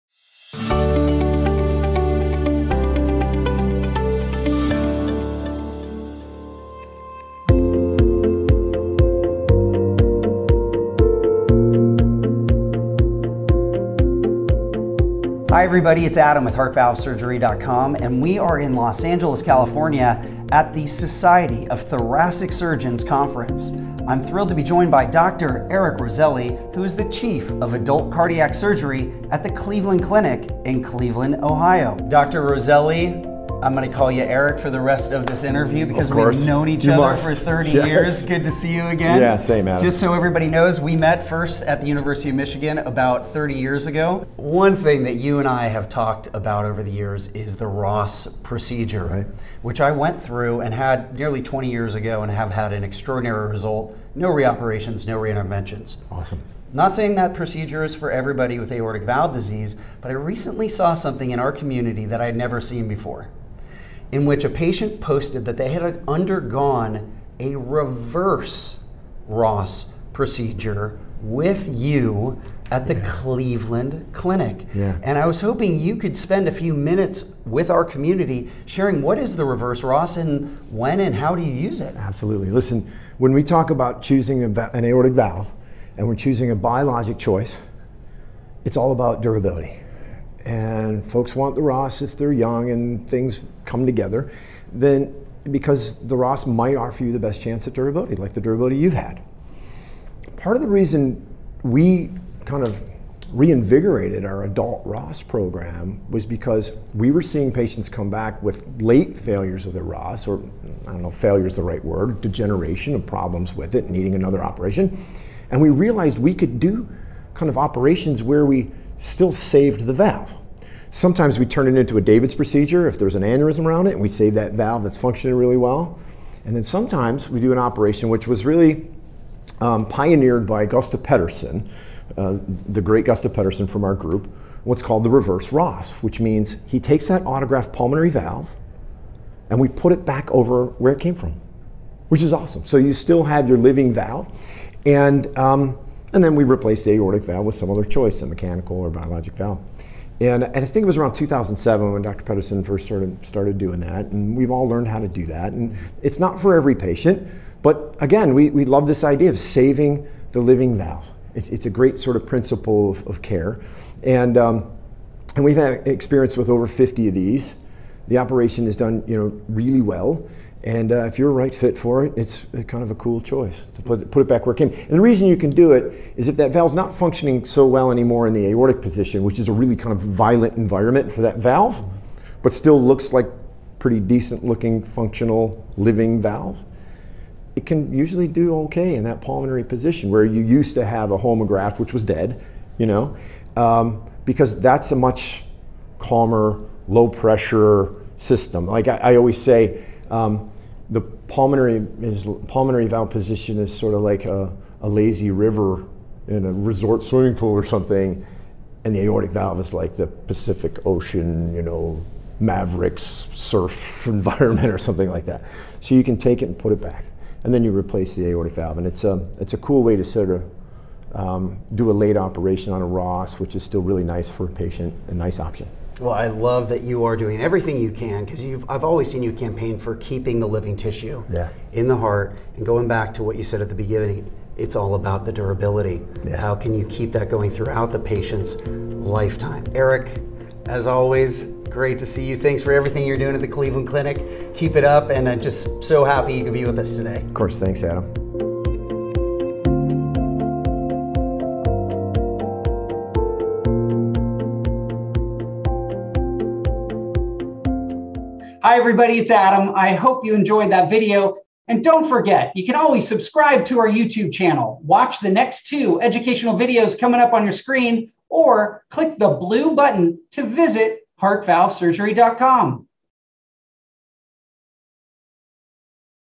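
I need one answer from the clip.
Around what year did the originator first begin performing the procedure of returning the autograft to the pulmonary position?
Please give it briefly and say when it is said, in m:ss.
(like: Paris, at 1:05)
2007, at 2:31.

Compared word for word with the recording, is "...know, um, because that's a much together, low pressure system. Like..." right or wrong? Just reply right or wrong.
wrong.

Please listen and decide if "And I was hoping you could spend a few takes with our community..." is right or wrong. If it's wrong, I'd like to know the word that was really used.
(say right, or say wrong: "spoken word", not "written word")
wrong: "minutes", not "takes".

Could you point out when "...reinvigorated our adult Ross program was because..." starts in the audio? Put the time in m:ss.
1:43.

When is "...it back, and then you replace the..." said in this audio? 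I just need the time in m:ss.
3:36.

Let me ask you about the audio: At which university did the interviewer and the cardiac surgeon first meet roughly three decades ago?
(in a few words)
University of Michigan.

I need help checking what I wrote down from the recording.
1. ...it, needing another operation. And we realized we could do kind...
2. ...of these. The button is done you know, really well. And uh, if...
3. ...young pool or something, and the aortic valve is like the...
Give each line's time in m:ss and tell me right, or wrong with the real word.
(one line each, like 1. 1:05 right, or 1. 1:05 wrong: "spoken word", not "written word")
1. 1:53 right
2. 2:47 wrong: "operation", not "button"
3. 3:27 wrong: "swimming", not "young".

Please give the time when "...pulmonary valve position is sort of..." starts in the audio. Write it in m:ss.
3:22.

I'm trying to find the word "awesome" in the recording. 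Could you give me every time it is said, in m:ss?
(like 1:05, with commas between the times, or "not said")
0:56, 2:22.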